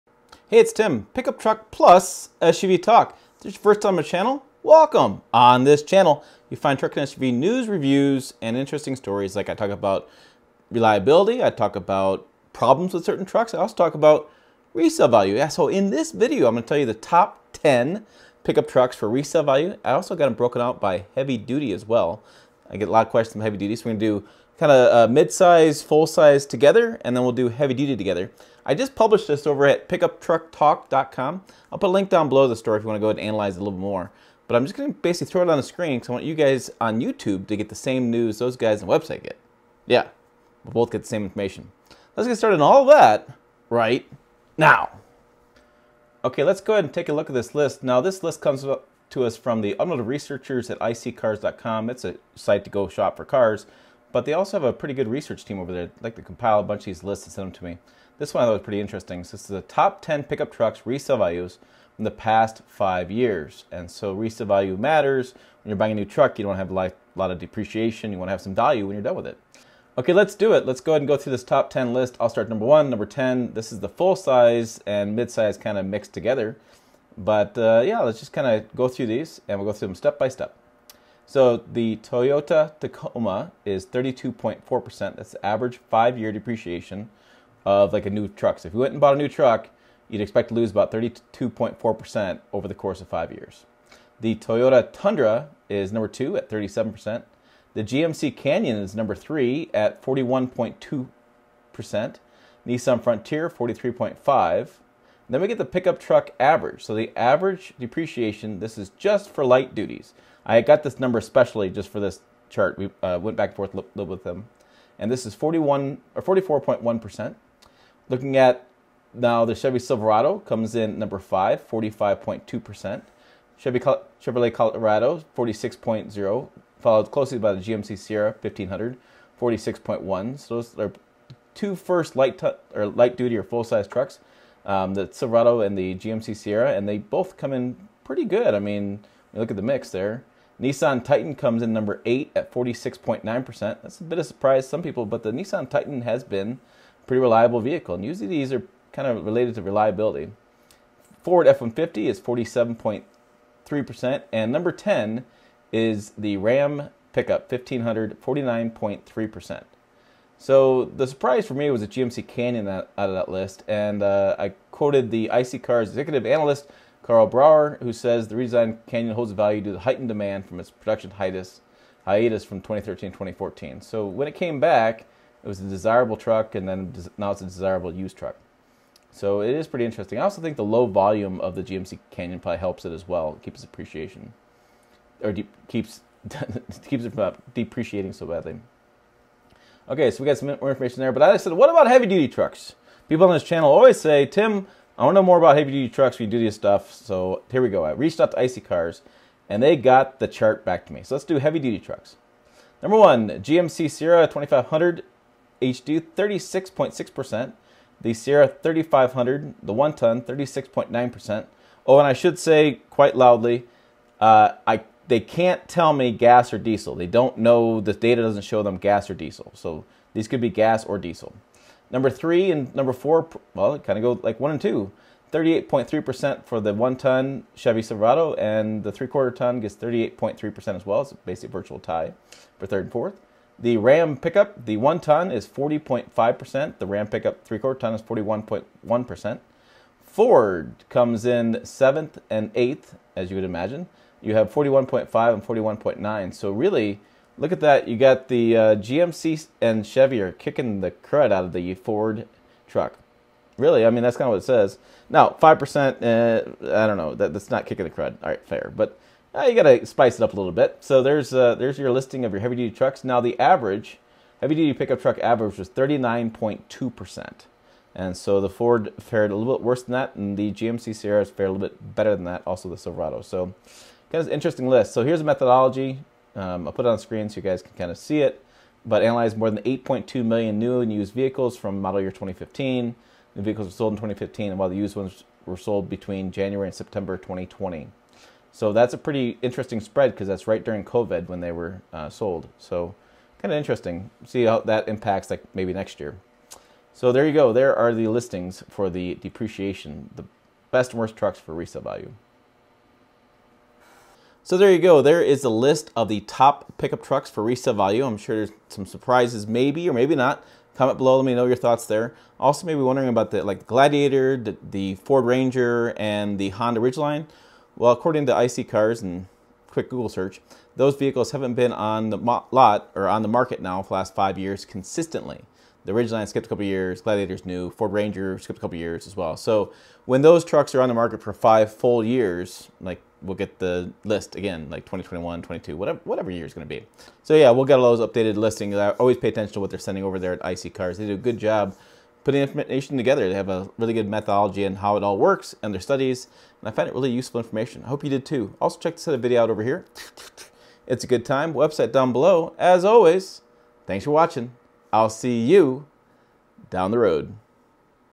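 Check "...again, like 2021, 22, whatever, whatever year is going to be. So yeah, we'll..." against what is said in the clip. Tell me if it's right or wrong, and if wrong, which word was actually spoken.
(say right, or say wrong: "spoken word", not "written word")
right.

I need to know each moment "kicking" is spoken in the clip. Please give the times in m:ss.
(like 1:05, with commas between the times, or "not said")
4:10, 4:17.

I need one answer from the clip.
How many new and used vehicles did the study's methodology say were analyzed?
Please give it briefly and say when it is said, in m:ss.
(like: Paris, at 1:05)
8.2 million, at 4:39.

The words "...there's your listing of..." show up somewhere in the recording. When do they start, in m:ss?
4:21.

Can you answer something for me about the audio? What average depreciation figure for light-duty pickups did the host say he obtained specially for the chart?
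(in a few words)
44.1%.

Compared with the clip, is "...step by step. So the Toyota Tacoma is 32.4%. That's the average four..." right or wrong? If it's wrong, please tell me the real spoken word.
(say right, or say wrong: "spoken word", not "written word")
wrong: "five", not "four".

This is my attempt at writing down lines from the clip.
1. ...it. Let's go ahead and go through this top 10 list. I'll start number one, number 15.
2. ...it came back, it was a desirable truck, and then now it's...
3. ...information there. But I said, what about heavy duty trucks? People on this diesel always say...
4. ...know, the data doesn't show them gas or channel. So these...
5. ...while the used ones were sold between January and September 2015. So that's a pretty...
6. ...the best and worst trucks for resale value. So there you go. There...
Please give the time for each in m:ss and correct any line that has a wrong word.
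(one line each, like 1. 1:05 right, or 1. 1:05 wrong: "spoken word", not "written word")
1. 1:10 wrong: "10", not "15"
2. 2:54 right
3. 3:10 wrong: "channel", not "diesel"
4. 3:37 wrong: "diesel", not "channel"
5. 4:44 wrong: "2020", not "2015"
6. 5:00 right.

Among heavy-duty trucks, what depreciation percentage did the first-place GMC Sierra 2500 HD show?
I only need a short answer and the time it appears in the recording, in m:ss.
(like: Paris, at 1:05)
36.6%, at 3:26.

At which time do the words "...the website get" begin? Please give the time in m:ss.
0:38.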